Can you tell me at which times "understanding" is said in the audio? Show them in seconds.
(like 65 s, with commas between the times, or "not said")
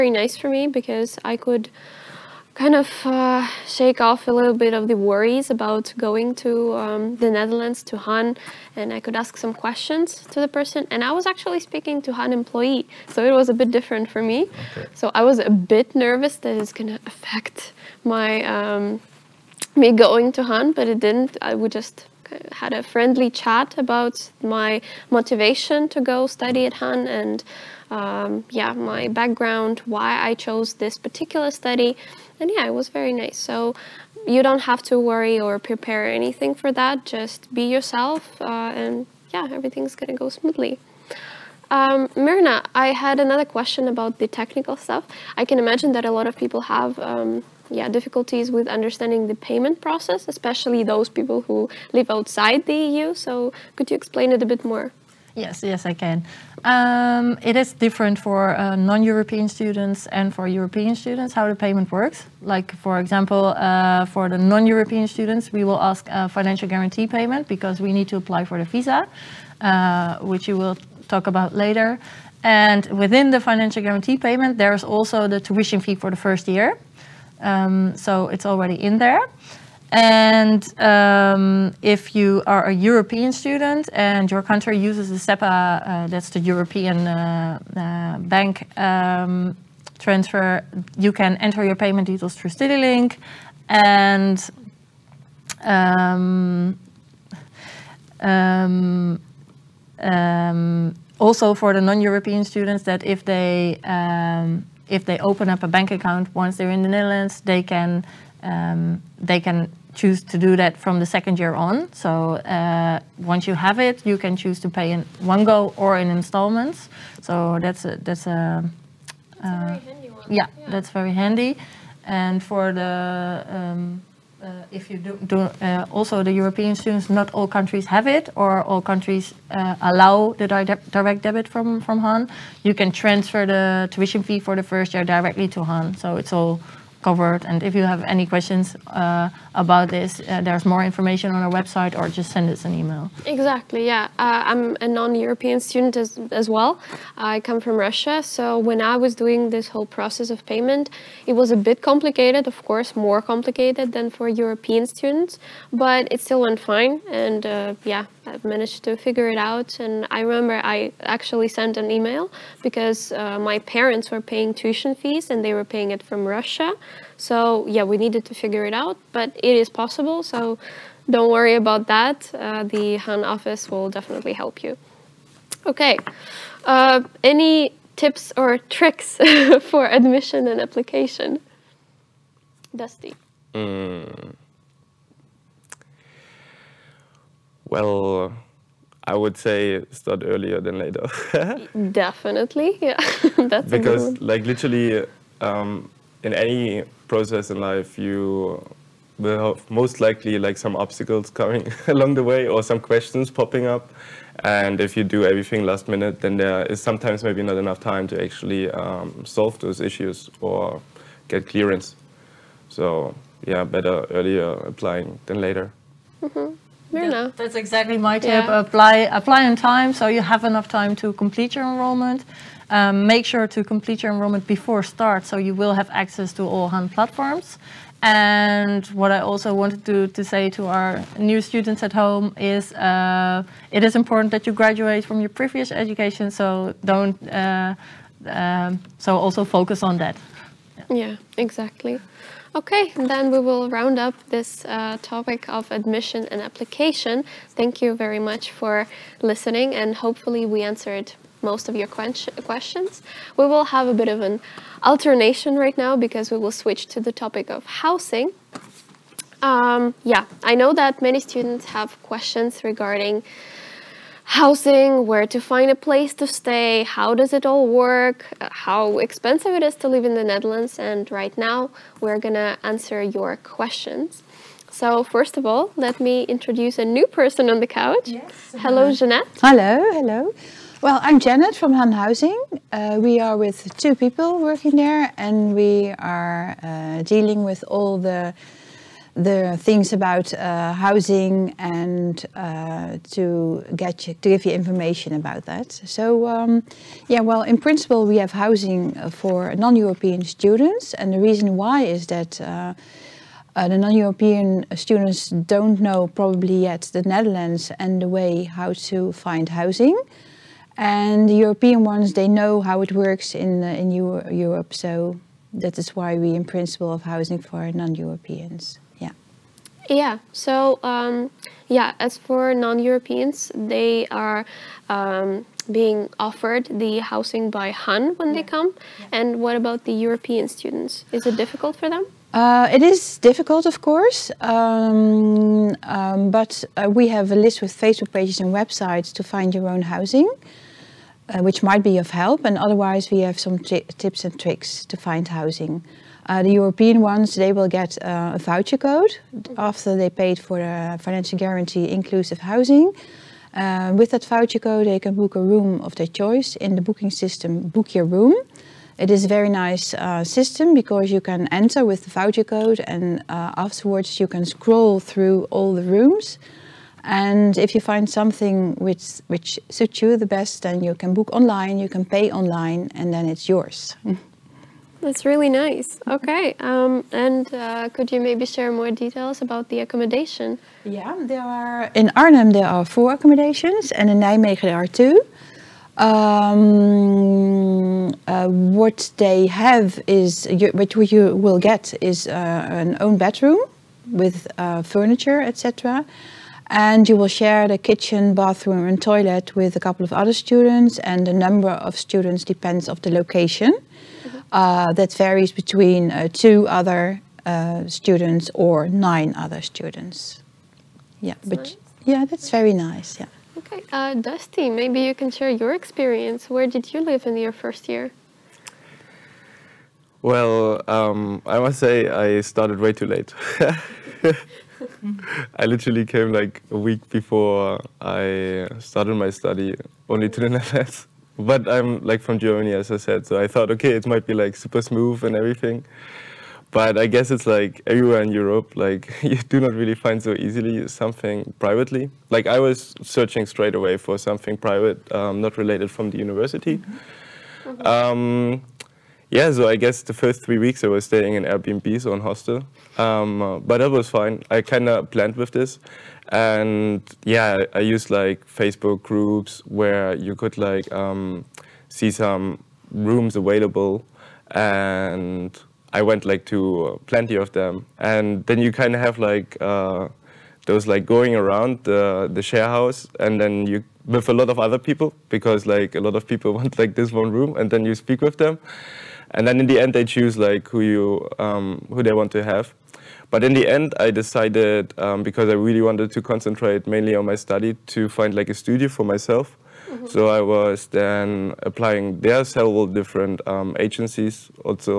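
48 s.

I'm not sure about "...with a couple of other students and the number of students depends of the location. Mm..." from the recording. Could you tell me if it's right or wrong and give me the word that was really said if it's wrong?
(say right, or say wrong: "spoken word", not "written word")
right.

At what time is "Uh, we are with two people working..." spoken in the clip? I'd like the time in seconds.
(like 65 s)
282 s.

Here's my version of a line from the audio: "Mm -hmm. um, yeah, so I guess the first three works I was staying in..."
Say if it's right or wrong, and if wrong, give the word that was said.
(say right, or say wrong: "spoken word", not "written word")
wrong: "weeks", not "works".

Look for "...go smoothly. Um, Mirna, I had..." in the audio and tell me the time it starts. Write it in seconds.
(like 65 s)
40 s.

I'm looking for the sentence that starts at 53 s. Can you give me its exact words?
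So could you explain it a bit more?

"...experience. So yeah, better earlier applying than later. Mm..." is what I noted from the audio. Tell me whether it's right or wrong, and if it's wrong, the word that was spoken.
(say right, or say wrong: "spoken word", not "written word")
wrong: "clearance", not "experience".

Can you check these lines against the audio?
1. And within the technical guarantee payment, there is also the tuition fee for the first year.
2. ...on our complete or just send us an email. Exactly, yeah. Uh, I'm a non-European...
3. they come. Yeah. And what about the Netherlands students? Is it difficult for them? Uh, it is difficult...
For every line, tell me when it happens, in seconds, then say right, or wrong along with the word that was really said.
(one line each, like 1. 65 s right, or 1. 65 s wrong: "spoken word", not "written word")
1. 72 s wrong: "financial", not "technical"
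2. 141 s wrong: "website", not "complete"
3. 328 s wrong: "European", not "Netherlands".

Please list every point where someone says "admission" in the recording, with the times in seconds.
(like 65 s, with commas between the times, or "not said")
179 s, 245 s.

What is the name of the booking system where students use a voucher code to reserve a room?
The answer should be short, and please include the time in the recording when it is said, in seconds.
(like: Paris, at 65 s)
Book Your Room, at 357 s.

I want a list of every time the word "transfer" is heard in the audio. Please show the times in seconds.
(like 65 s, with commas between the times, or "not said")
89 s, 132 s.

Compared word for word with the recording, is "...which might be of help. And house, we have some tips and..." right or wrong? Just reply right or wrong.
wrong.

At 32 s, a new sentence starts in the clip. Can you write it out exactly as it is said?
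And yeah, it was very nice.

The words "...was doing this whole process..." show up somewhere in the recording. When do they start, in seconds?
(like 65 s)
148 s.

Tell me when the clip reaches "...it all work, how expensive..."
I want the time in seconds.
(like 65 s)
267 s.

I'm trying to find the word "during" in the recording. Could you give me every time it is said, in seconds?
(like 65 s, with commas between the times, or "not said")
not said.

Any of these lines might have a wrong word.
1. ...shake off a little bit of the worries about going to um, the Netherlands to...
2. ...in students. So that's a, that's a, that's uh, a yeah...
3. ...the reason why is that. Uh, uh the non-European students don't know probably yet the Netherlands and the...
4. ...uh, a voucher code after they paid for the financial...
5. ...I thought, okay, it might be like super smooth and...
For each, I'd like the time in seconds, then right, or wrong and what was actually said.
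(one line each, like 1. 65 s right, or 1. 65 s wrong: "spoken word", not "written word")
1. 3 s right
2. 115 s wrong: "installments", not "students"
3. 301 s right
4. 348 s right
5. 433 s right.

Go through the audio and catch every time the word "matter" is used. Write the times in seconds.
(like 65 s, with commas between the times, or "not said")
not said.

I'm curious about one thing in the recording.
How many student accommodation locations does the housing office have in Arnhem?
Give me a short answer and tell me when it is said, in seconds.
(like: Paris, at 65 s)
4, at 382 s.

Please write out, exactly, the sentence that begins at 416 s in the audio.
Where did you live in your first year?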